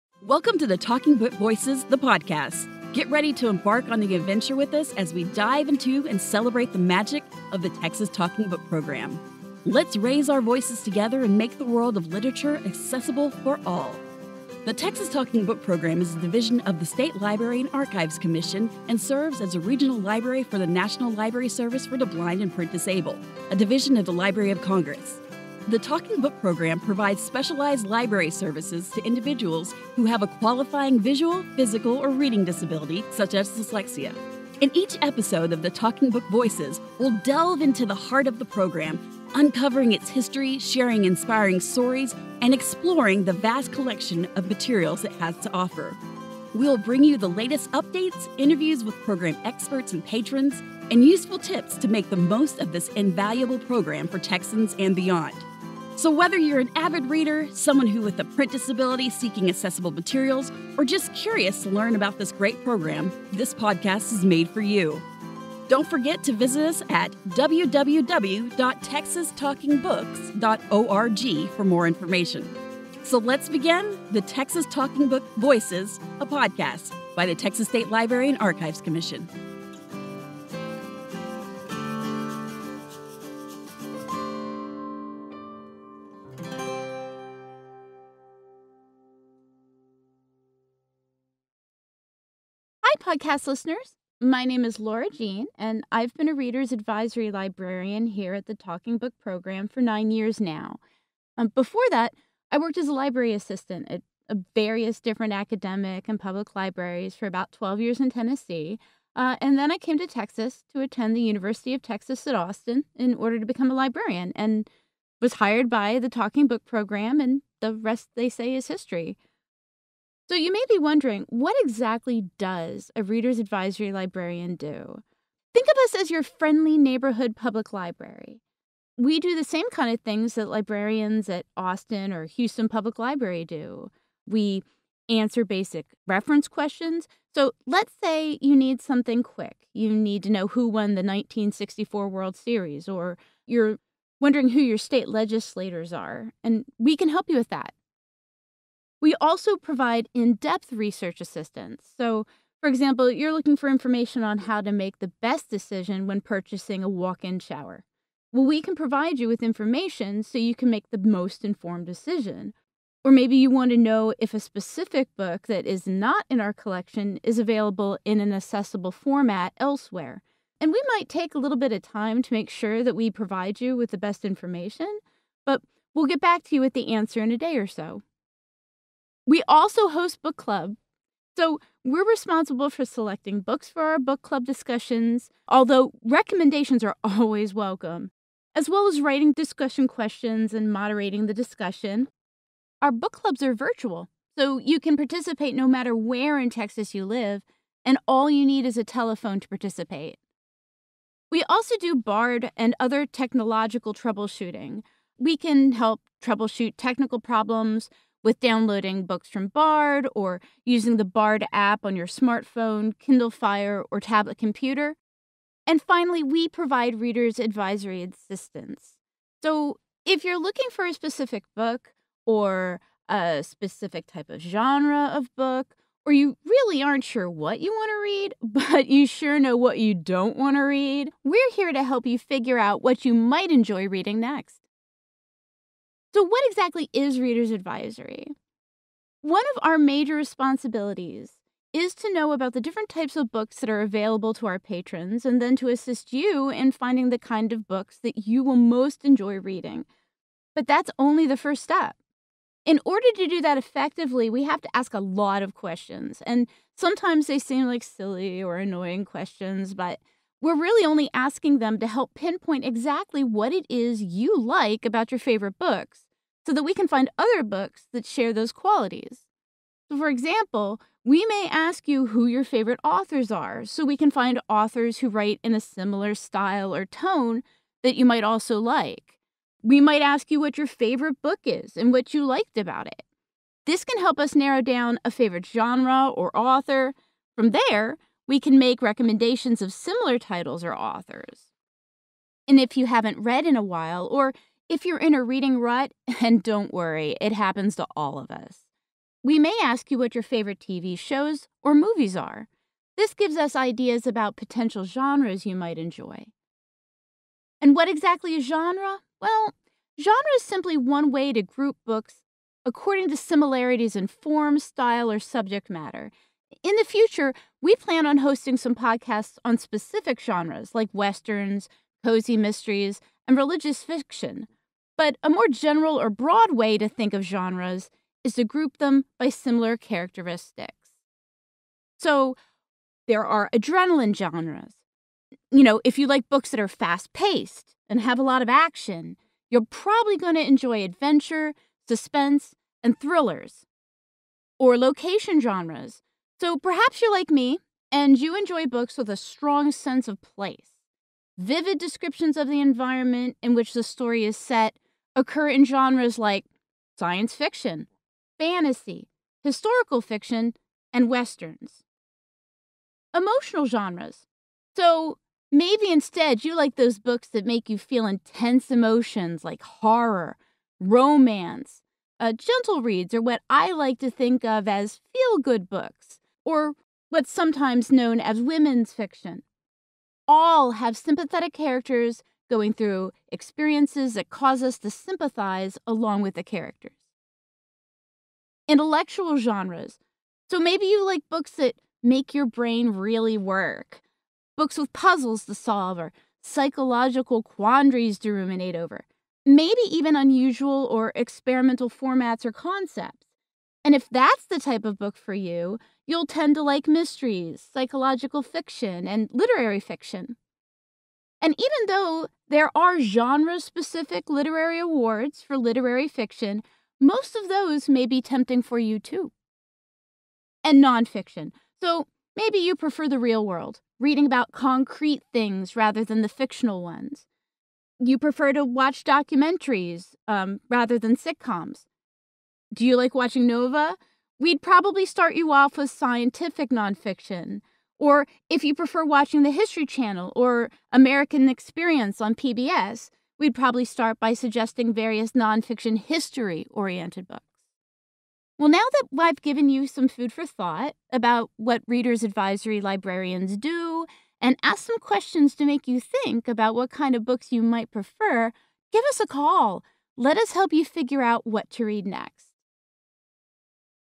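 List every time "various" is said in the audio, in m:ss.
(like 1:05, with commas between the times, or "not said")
1:44, 7:24.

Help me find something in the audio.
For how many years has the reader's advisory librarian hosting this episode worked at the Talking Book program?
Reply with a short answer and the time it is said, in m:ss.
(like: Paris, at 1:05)
9, at 1:39.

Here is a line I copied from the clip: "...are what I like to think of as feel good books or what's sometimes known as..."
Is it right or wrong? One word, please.
right.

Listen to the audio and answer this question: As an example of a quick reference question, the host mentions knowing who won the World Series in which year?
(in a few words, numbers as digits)
1964.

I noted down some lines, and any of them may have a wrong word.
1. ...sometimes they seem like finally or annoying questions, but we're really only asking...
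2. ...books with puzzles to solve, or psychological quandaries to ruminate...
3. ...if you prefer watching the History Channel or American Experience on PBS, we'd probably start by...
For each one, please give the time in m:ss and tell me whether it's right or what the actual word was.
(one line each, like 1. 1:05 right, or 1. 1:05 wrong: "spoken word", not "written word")
1. 4:16 wrong: "silly", not "finally"
2. 6:34 right
3. 7:18 right.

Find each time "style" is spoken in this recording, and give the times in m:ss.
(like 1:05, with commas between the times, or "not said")
4:36, 5:14.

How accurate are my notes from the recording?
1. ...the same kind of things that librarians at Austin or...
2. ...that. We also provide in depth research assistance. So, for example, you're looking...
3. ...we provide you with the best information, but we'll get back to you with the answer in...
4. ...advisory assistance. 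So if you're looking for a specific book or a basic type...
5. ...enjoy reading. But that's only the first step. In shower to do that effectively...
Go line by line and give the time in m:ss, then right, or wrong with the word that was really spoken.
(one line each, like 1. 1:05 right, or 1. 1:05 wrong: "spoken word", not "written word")
1. 2:09 right
2. 2:27 right
3. 2:52 right
4. 3:37 wrong: "specific", not "basic"
5. 4:09 wrong: "order", not "shower".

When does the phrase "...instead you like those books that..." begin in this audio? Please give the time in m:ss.
6:05.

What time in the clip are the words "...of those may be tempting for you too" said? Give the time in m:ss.
6:57.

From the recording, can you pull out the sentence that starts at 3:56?
So, what exactly is Reader's Advisory?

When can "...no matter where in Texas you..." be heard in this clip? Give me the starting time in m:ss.
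3:15.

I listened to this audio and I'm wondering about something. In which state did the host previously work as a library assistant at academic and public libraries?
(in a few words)
Tennessee.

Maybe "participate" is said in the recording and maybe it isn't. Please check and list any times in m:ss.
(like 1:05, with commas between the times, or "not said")
3:14, 3:19.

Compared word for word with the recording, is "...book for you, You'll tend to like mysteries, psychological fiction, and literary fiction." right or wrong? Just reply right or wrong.
right.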